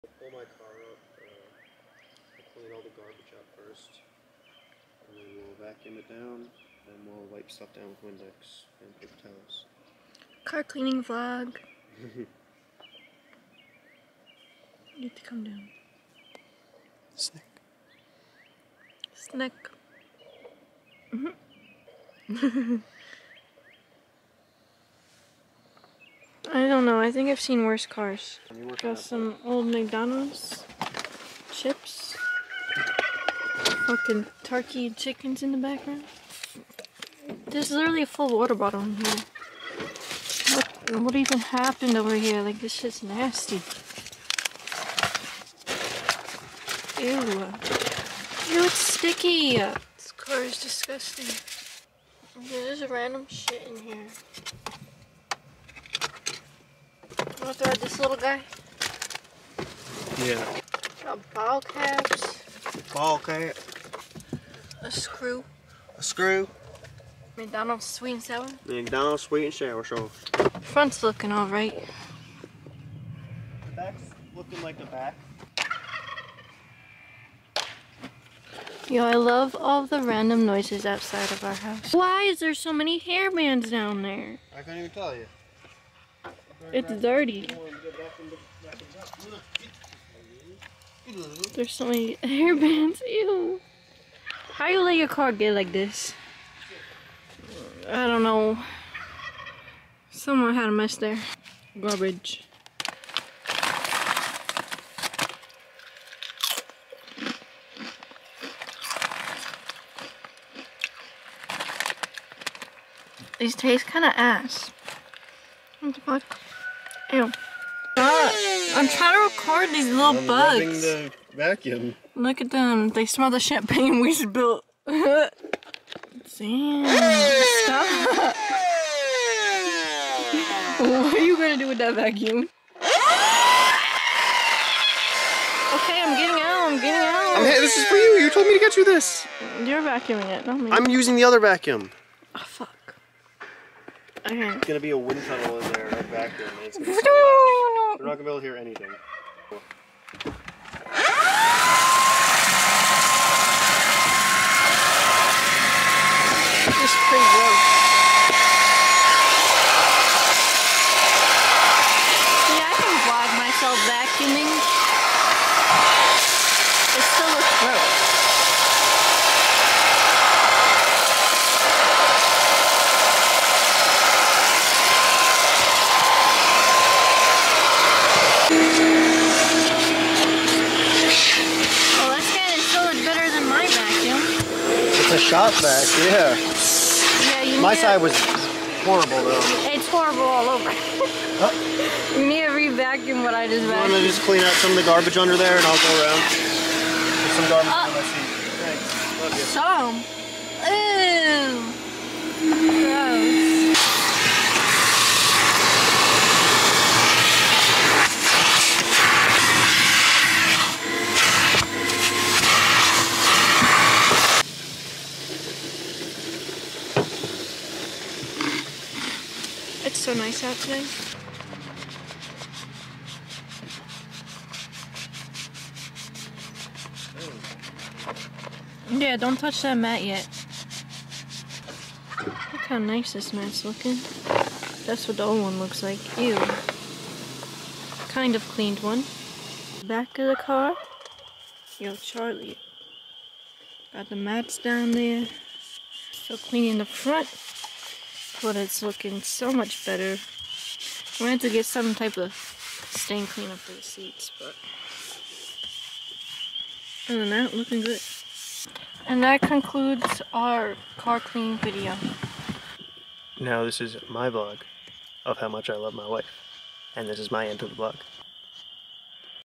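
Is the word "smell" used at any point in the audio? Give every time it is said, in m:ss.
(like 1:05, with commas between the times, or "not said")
2:03.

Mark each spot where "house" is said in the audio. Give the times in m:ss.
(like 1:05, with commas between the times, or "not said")
1:21.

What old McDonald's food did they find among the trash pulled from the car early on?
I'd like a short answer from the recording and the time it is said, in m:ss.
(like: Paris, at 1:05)
chips, at 0:31.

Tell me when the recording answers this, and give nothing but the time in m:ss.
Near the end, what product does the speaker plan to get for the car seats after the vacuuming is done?
4:12.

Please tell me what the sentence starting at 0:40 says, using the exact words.
What, what even happened over here?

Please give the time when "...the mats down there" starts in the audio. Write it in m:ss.
4:04.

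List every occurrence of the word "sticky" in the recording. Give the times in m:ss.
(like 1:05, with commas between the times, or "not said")
0:48.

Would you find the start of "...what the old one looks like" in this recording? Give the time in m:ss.
3:55.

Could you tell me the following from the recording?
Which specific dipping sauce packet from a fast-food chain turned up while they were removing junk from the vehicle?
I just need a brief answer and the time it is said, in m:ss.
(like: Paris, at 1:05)
McDonald's sweet and sour, at 1:08.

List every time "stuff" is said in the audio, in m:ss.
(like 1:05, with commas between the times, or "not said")
0:07.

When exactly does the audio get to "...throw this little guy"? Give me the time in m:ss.
0:57.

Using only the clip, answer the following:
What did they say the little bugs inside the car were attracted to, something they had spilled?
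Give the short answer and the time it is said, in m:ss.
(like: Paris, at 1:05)
champagne, at 2:03.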